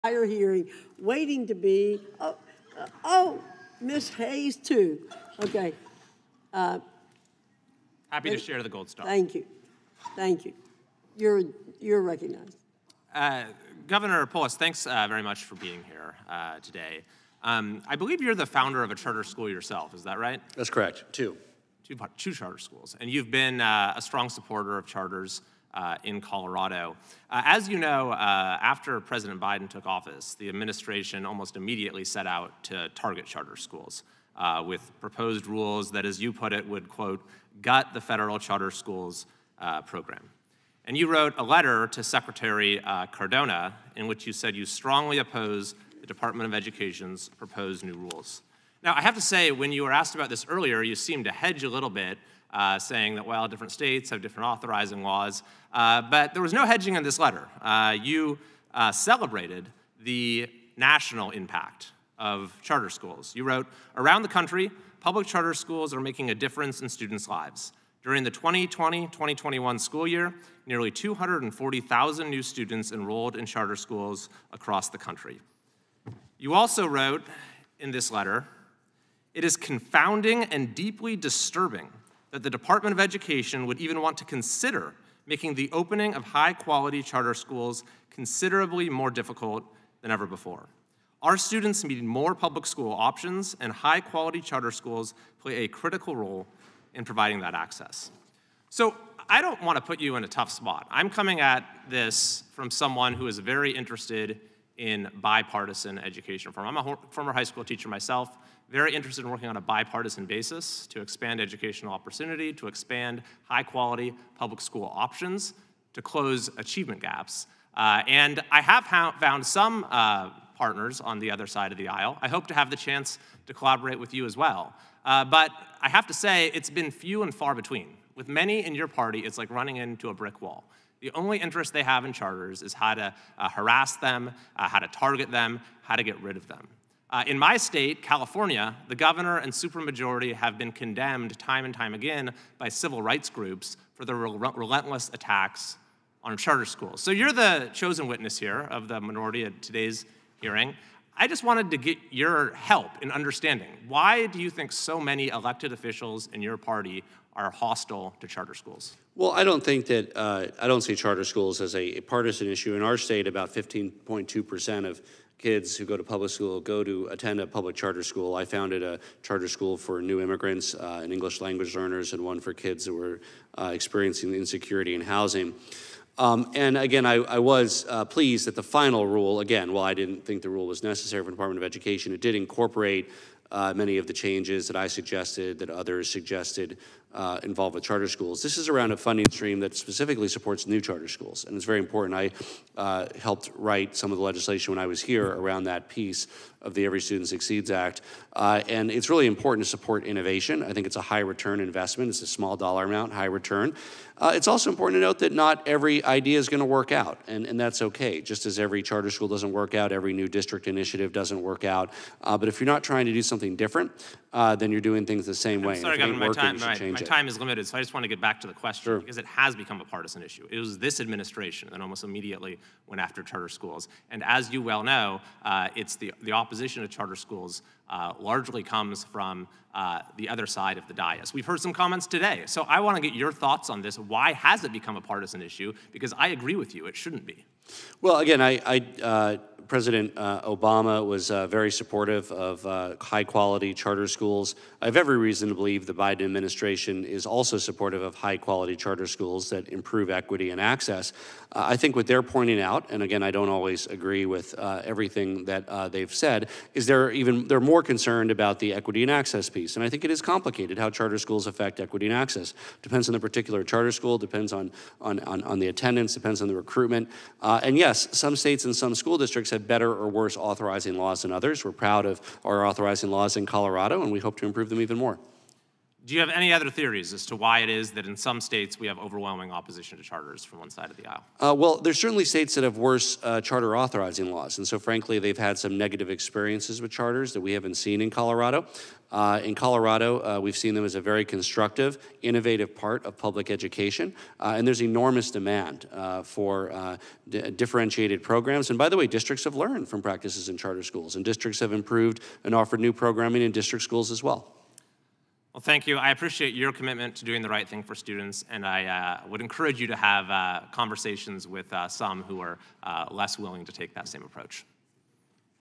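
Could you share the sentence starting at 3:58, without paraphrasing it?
Well, again, I, I uh, President uh, Obama was uh, very supportive of uh, high quality charter schools.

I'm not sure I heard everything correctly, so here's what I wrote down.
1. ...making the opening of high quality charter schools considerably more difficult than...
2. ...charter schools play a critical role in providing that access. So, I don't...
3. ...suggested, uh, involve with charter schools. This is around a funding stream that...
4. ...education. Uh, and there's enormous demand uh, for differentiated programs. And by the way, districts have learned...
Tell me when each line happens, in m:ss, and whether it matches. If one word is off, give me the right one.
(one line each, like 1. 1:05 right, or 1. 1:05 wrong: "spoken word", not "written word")
1. 1:25 right
2. 1:34 right
3. 3:06 right
4. 4:53 right.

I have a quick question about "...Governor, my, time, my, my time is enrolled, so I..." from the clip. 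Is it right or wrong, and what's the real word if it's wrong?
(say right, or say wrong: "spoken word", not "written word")
wrong: "limited", not "enrolled".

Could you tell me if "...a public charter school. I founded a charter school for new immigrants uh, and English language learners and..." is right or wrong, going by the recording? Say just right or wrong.
right.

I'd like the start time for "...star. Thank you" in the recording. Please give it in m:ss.
0:08.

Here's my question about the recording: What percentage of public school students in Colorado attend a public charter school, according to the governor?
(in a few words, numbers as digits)
15.2 percent.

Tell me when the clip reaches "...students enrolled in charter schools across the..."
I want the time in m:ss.
1:12.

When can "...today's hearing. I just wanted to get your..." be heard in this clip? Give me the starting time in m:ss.
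2:29.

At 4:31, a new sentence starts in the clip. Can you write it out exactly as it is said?
We're proud of our authorizing laws in Colorado, and we hope to improve them even more.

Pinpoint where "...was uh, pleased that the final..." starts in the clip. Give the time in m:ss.
2:57.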